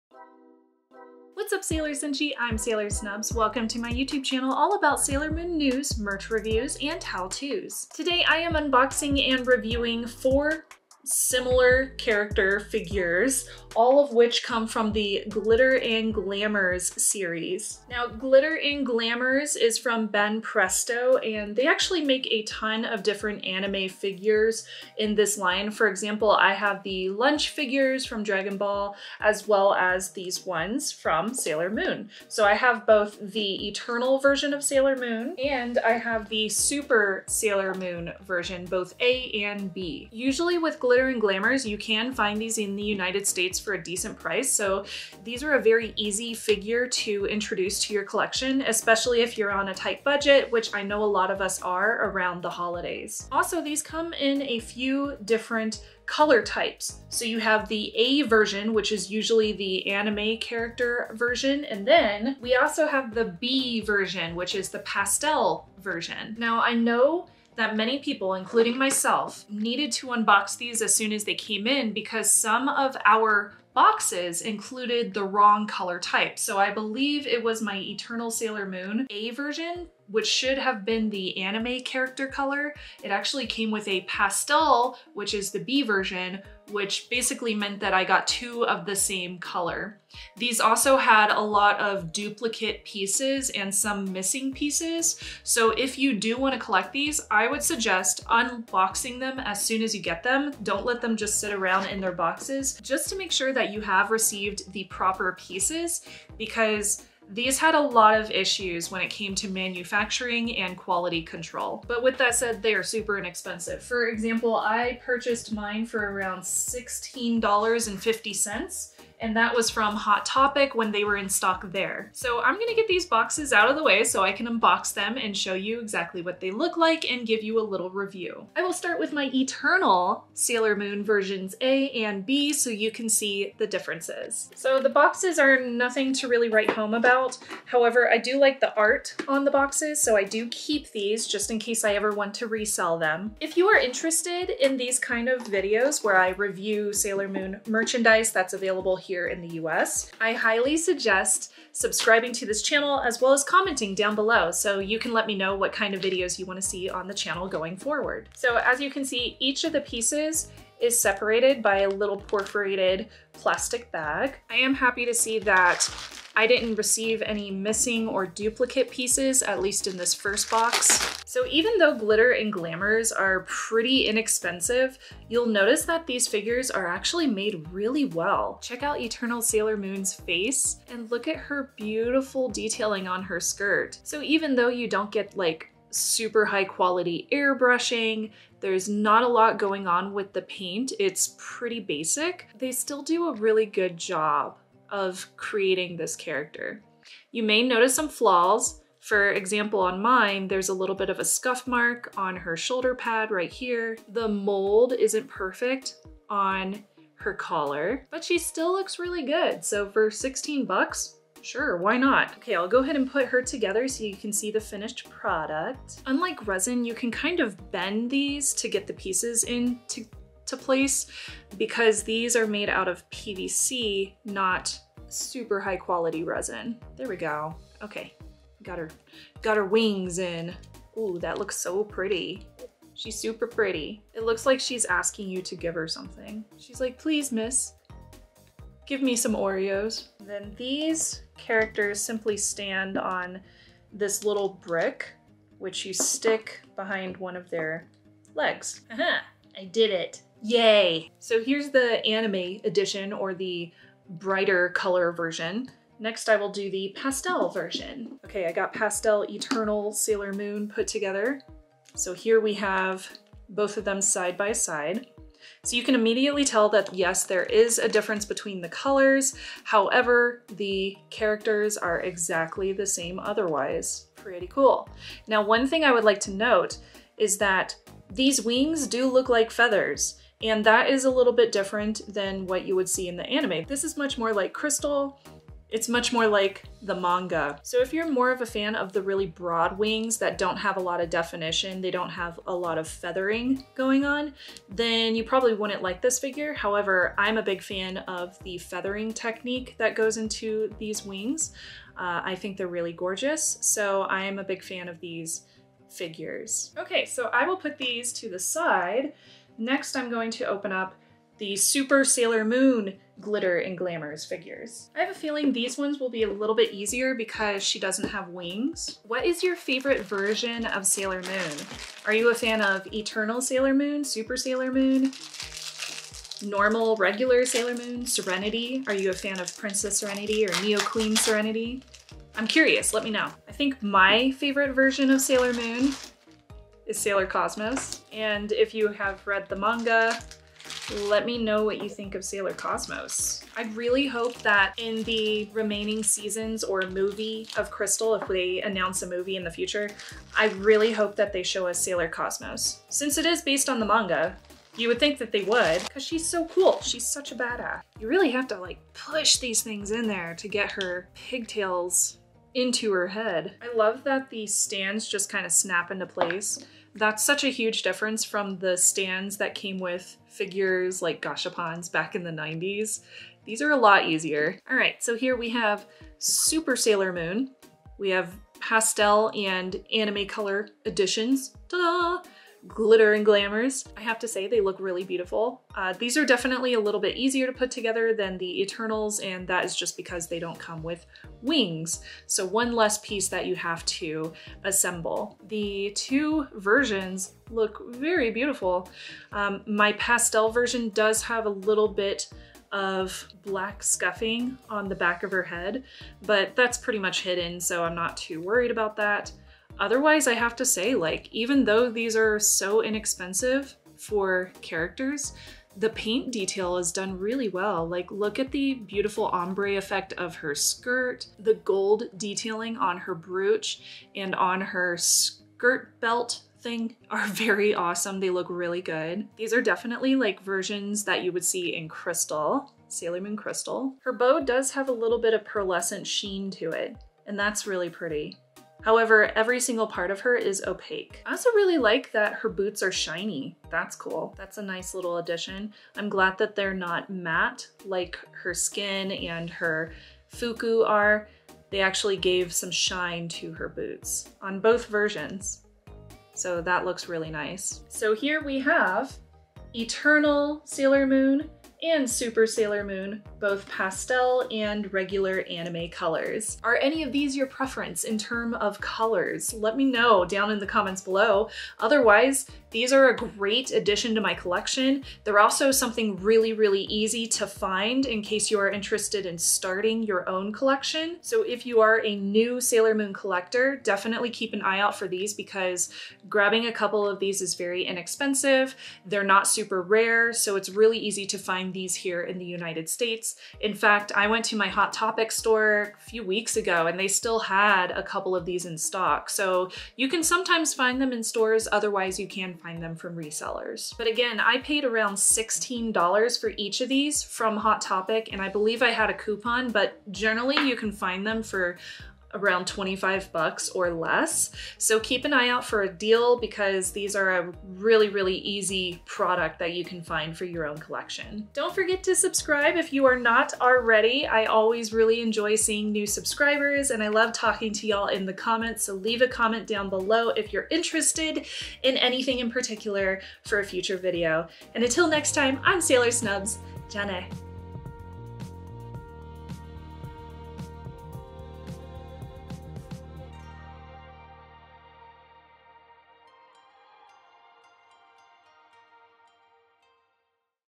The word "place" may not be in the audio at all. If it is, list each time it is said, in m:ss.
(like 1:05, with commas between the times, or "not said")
3:40, 6:06.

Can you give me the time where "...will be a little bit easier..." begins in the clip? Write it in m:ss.
5:15.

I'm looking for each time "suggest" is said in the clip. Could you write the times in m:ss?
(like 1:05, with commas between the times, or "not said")
1:37, 2:30.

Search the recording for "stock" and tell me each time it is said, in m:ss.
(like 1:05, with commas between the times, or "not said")
2:01, 8:18.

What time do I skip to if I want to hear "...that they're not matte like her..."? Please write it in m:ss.
7:26.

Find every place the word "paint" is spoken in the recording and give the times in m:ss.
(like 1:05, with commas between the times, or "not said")
3:10, 6:55.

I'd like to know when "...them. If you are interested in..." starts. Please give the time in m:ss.
2:22.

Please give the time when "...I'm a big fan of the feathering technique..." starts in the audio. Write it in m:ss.
4:57.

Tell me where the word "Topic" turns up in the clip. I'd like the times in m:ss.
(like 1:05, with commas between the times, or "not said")
2:00, 8:14, 8:27.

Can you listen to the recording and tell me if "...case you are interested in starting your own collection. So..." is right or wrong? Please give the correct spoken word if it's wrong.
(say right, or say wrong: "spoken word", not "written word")
right.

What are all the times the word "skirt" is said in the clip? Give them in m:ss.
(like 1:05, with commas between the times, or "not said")
3:03, 7:00, 7:04.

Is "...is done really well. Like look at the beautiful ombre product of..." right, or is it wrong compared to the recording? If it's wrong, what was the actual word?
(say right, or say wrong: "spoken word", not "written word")
wrong: "effect", not "product".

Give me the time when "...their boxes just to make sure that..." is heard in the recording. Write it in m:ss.
1:42.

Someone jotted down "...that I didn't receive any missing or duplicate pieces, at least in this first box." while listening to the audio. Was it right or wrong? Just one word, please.
right.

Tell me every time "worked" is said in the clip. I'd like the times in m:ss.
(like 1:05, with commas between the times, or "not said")
not said.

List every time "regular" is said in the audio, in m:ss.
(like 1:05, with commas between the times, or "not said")
5:26, 7:44.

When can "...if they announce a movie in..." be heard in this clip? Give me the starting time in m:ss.
5:48.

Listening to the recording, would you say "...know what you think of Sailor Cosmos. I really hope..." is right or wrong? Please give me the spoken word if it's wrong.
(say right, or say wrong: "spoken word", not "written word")
right.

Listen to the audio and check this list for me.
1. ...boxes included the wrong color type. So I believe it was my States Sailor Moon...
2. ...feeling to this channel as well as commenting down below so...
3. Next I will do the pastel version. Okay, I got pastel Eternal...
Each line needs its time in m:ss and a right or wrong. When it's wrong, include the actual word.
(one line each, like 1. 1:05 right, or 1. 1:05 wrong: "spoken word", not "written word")
1. 1:13 wrong: "Eternal", not "States"
2. 2:31 wrong: "subscribing", not "feeling"
3. 4:15 right.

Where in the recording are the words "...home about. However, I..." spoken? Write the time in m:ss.
2:16.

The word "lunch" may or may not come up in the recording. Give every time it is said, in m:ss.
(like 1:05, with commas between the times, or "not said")
0:27.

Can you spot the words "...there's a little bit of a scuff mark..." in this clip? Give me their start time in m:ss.
3:20.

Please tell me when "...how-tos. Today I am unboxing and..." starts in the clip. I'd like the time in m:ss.
0:07.